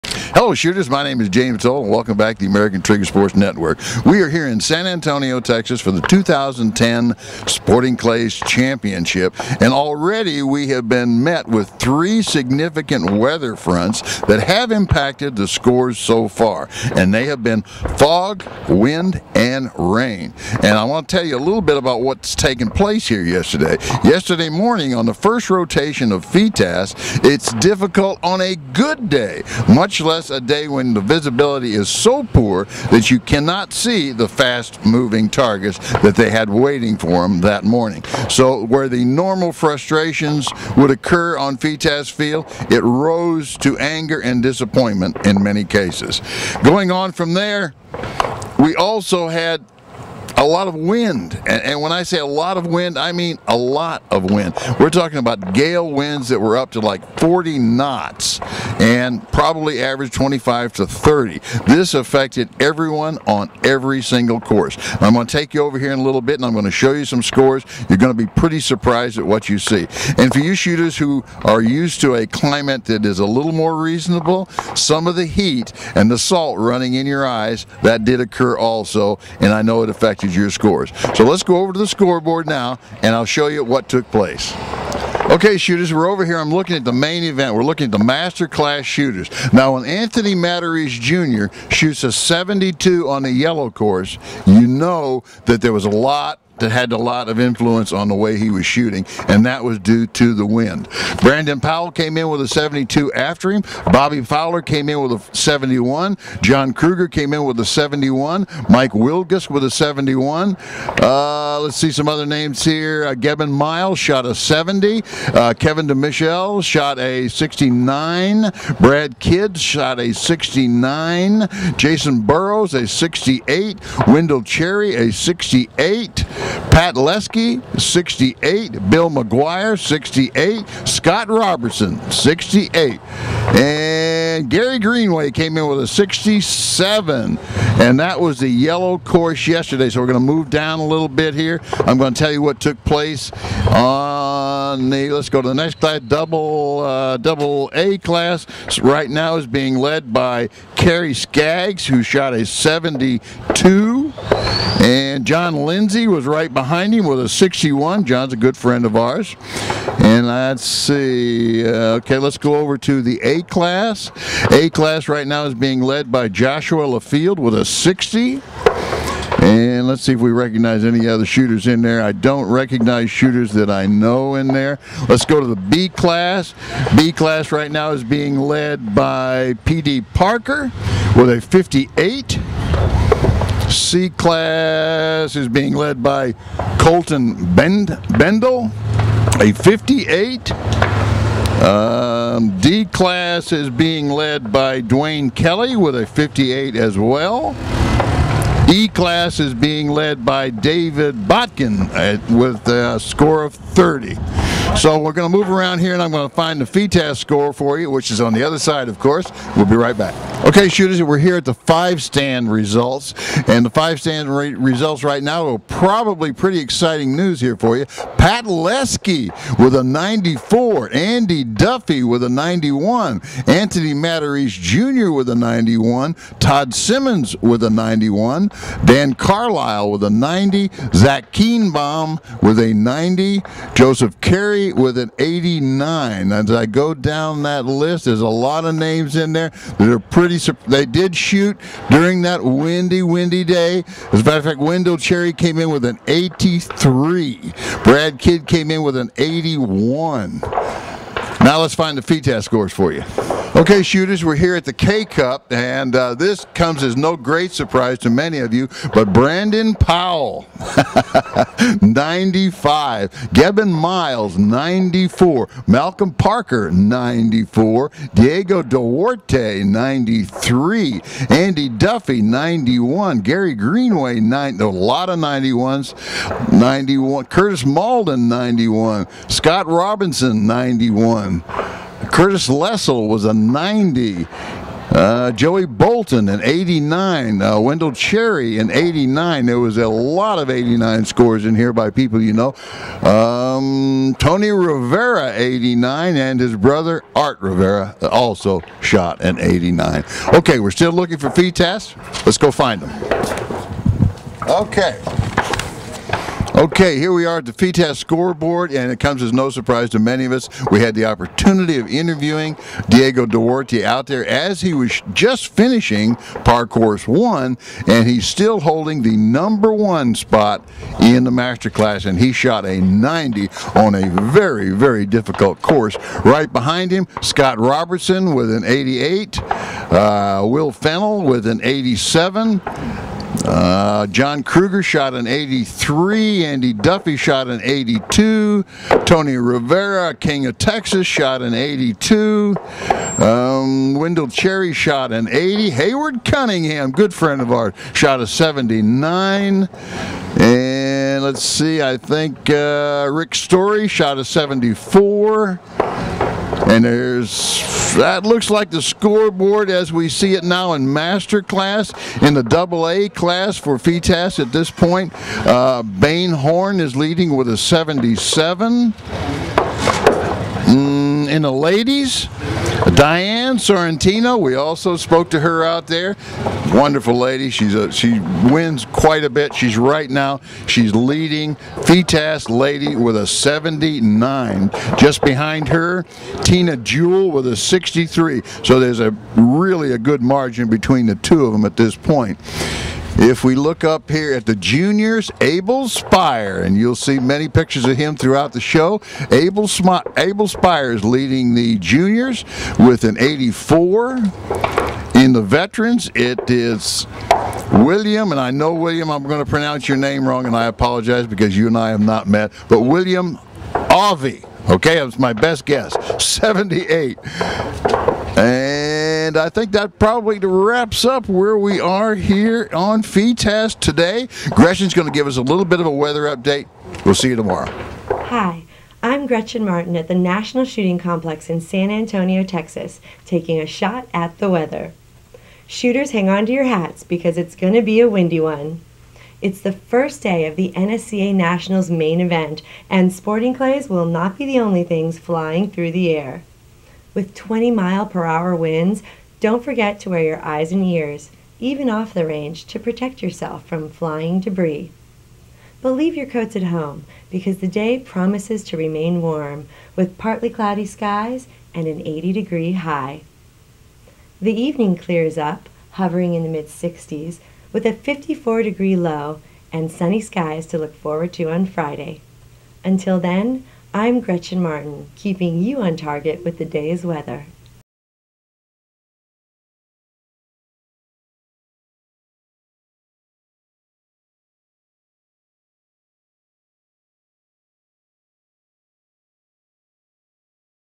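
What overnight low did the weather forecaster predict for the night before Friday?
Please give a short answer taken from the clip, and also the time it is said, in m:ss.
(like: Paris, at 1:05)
54 degrees, at 7:47.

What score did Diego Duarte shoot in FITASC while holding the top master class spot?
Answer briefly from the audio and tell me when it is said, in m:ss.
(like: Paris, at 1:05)
90, at 5:22.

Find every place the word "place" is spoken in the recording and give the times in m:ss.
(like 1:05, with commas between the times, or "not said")
0:22, 1:24, 2:22.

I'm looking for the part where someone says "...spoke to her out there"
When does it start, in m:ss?
6:14.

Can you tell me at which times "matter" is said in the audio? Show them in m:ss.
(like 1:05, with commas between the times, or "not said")
4:04.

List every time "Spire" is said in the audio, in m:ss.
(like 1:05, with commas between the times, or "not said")
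6:35, 6:40.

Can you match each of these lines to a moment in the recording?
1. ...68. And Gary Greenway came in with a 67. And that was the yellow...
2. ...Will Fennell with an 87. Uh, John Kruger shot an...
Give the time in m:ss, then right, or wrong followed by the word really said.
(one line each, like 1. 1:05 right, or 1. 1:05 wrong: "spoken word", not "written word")
1. 2:12 right
2. 5:30 right.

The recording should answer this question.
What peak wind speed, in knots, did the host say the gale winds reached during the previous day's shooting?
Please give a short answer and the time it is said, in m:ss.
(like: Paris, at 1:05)
40, at 0:57.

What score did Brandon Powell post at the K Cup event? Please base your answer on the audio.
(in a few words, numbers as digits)
95.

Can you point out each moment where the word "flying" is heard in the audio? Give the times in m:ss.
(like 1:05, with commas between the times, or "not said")
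7:25, 7:33.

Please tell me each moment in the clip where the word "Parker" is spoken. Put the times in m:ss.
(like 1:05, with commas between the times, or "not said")
3:00, 4:26.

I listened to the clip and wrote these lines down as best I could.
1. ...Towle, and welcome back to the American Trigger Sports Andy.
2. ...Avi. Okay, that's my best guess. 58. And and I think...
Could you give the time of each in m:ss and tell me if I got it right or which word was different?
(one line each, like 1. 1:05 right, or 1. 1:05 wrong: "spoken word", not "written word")
1. 0:01 wrong: "Network", not "Andy"
2. 6:53 wrong: "78", not "58".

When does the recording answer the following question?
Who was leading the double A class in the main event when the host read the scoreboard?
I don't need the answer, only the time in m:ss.
2:30.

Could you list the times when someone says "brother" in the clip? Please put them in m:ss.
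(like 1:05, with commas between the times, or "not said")
4:56.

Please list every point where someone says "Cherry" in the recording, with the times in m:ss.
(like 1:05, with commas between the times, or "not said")
2:04, 4:04, 4:47, 5:44.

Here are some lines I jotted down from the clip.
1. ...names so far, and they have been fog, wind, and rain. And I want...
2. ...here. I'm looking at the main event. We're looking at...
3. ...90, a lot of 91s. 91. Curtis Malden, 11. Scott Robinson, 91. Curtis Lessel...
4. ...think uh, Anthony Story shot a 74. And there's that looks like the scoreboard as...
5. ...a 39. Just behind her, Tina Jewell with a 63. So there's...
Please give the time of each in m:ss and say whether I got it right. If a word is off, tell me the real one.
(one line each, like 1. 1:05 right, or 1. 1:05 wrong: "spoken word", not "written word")
1. 0:15 wrong: "scores", not "names"
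2. 1:26 right
3. 4:34 wrong: "91", not "11"
4. 5:51 wrong: "Rick", not "Anthony"
5. 6:23 wrong: "79", not "39".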